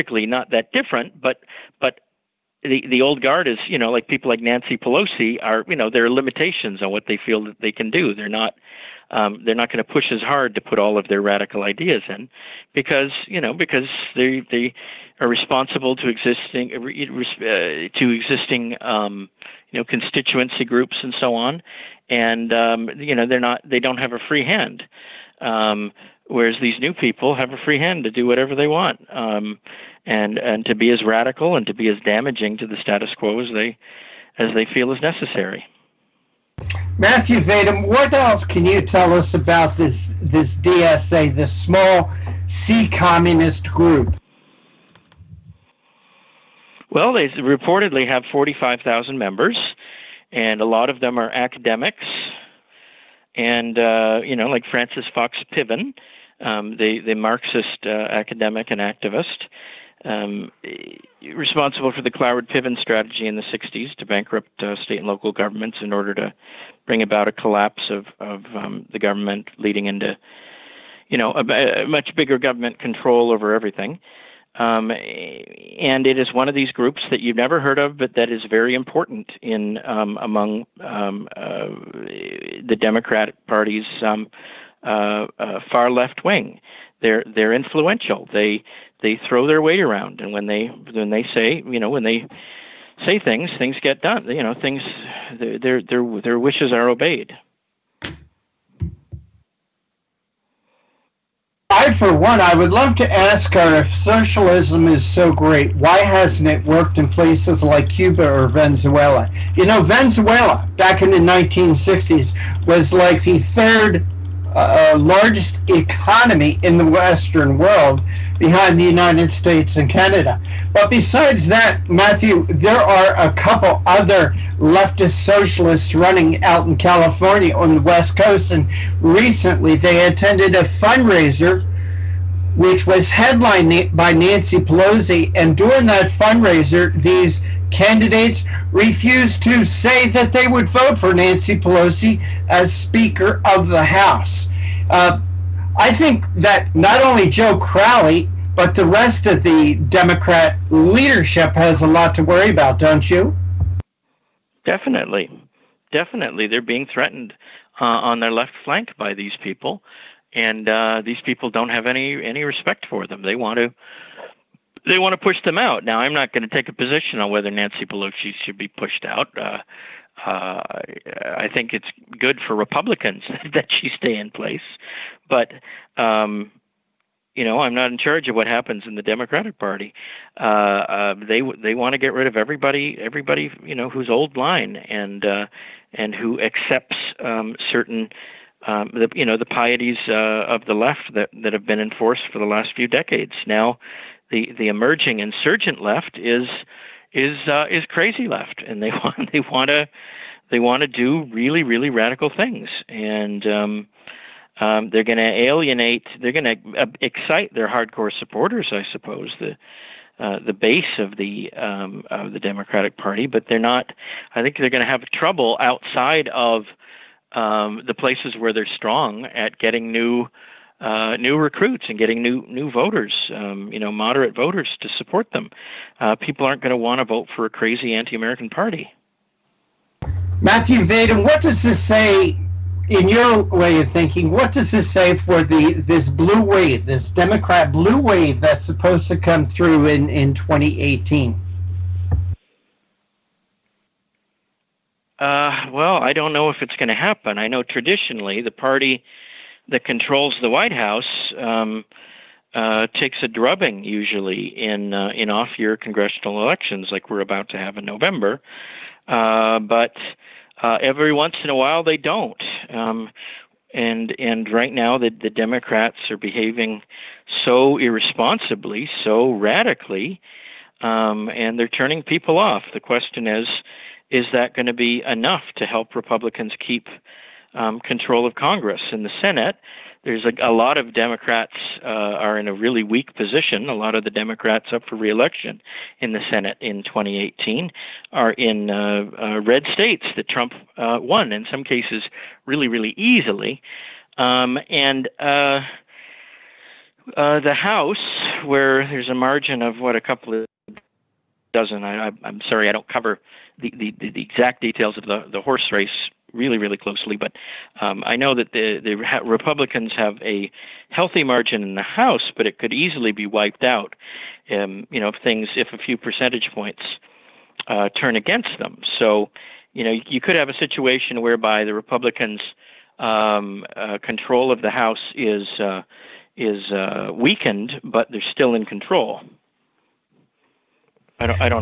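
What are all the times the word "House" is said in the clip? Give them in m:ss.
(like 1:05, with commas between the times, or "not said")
2:23, 4:10, 4:57, 5:11, 5:24.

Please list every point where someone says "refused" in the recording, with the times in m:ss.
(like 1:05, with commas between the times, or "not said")
2:18.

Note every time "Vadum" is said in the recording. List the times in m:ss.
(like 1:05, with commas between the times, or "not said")
0:37, 3:50.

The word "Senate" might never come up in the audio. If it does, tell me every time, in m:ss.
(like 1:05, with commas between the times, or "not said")
4:39, 4:46.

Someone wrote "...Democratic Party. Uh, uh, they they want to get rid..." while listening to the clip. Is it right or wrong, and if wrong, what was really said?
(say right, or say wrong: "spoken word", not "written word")
right.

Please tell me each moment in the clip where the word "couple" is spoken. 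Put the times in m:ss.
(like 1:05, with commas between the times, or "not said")
2:03, 5:00.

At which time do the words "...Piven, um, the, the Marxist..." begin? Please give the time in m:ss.
0:55.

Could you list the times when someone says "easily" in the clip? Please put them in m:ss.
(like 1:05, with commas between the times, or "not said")
4:52, 5:12.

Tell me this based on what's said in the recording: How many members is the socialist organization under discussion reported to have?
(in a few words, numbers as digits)
45,000.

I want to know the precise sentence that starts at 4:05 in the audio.
Uh, well, I don't know if it's going to happen.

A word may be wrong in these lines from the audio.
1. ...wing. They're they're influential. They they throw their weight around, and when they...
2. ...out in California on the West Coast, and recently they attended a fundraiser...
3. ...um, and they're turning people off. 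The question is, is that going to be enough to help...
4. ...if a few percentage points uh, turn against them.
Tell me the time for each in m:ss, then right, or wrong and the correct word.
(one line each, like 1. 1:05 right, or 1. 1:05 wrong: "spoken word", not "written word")
1. 1:26 right
2. 2:06 right
3. 4:30 right
4. 5:15 right.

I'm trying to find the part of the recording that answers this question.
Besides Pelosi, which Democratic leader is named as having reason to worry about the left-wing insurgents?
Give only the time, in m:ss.
2:27.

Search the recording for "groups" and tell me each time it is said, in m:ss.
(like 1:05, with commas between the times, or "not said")
0:20, 0:43, 1:16.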